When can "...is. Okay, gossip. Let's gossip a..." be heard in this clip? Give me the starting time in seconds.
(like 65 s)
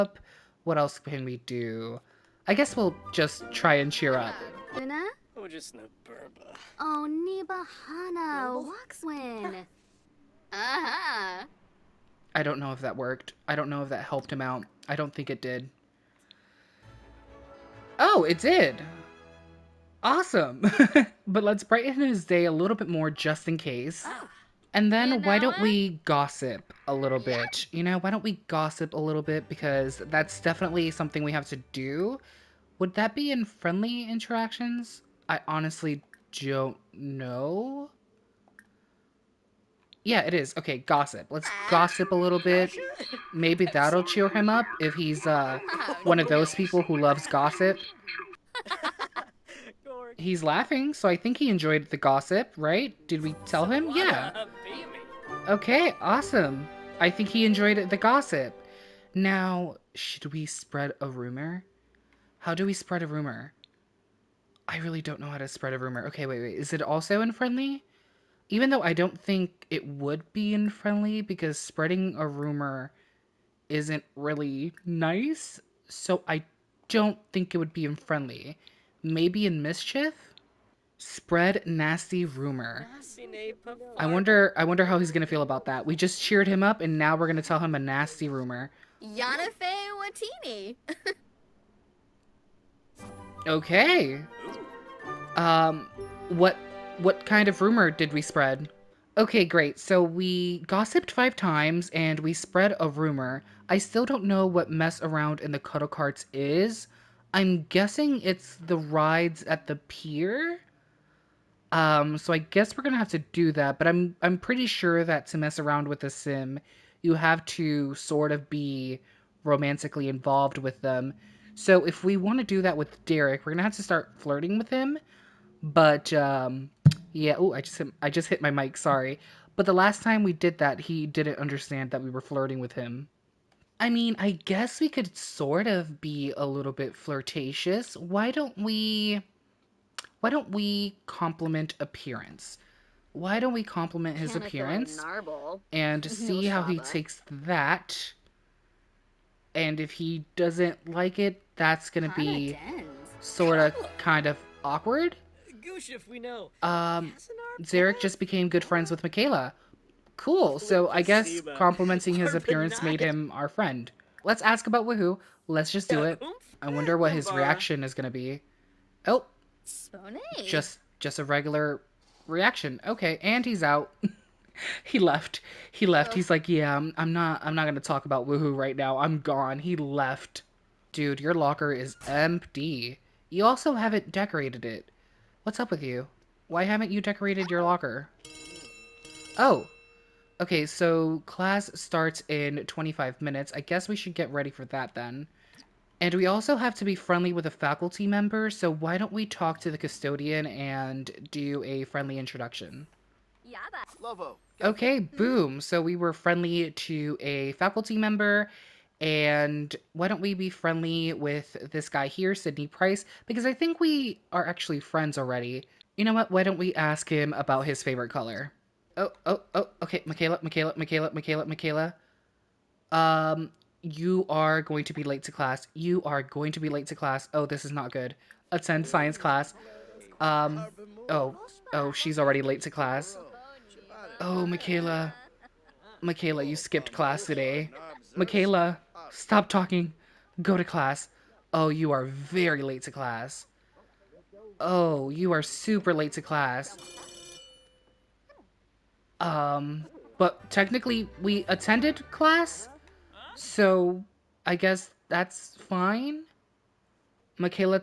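40 s.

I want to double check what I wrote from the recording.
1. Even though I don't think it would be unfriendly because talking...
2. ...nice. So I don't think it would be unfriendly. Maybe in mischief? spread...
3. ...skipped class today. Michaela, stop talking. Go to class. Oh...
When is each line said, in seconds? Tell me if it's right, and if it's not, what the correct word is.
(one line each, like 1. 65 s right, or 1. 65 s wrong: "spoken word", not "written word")
1. 68 s wrong: "spreading", not "talking"
2. 74 s right
3. 236 s right.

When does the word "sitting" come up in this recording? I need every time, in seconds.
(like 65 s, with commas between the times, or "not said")
not said.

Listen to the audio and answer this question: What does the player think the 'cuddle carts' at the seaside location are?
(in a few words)
rides at the pier.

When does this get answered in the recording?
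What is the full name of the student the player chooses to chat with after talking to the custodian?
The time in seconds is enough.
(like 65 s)
212 s.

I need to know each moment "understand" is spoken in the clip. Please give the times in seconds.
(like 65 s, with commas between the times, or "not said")
131 s.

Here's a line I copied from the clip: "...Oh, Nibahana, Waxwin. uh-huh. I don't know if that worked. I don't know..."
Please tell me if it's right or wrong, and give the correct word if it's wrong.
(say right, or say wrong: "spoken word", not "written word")
right.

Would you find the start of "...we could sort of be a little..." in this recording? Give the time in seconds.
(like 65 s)
134 s.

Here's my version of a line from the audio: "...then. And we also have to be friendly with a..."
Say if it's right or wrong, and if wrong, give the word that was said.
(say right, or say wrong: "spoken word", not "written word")
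right.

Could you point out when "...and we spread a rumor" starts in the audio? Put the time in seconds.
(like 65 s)
101 s.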